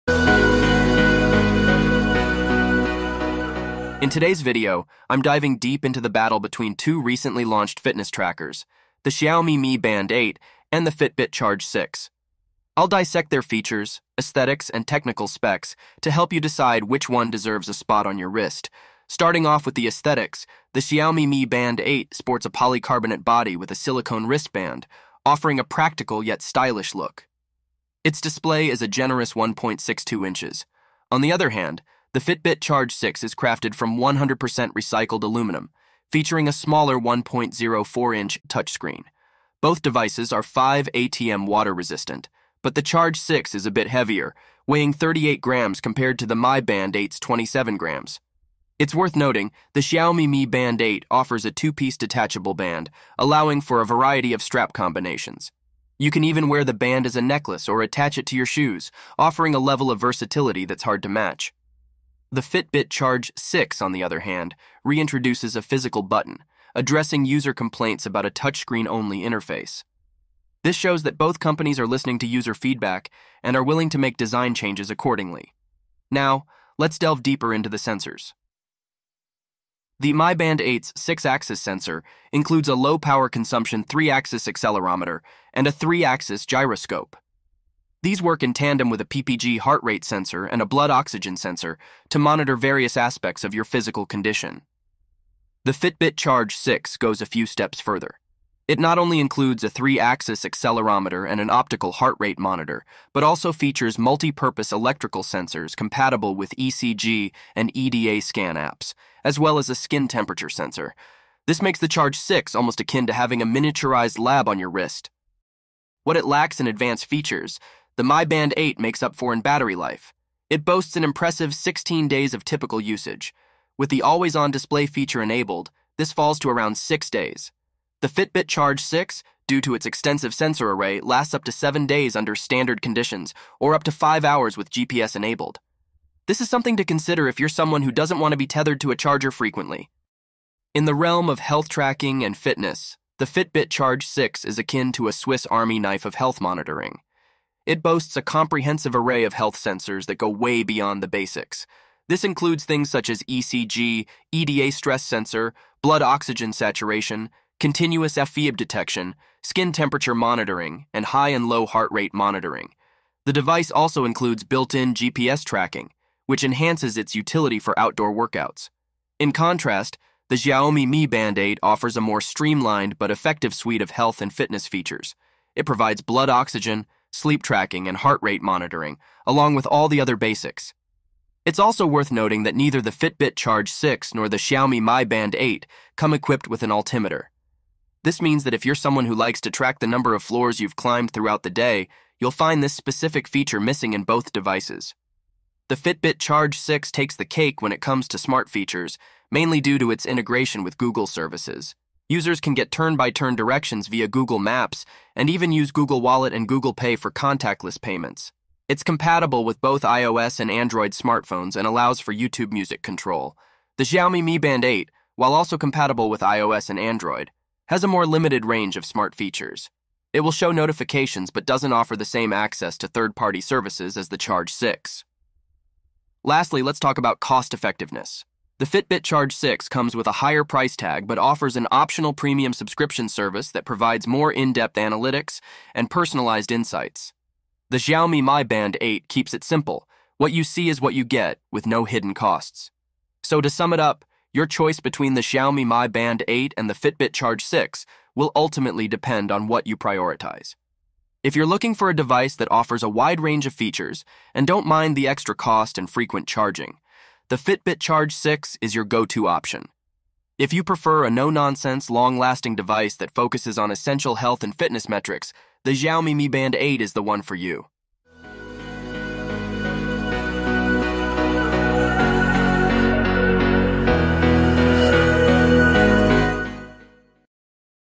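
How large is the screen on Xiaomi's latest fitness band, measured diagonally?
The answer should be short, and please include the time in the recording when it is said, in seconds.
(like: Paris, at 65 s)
1.62 inches, at 29 s.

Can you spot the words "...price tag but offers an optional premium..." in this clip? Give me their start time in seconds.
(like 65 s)
230 s.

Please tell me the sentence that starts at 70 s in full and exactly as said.
This shows that both companies are listening to user feedback and are willing to make design changes accordingly.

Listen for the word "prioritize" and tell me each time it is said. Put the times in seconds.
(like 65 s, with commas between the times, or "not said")
249 s.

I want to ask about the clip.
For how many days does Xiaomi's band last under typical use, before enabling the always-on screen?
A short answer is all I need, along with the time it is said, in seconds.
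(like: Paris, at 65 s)
16 days, at 121 s.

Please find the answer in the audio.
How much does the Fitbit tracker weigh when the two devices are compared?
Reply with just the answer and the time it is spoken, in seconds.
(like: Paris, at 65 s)
38 grams, at 44 s.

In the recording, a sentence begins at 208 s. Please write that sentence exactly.
It's compatible with both iOS and Android smartphones and allows for YouTube Music control.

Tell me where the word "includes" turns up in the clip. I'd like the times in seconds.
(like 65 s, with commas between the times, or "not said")
82 s, 99 s, 152 s, 164 s.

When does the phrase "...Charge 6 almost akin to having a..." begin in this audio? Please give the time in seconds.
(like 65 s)
111 s.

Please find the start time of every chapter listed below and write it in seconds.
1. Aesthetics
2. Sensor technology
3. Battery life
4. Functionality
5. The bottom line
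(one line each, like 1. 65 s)
1. 19 s
2. 77 s
3. 117 s
4. 141 s
5. 242 s.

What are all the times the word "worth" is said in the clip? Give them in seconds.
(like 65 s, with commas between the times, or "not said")
48 s, 181 s.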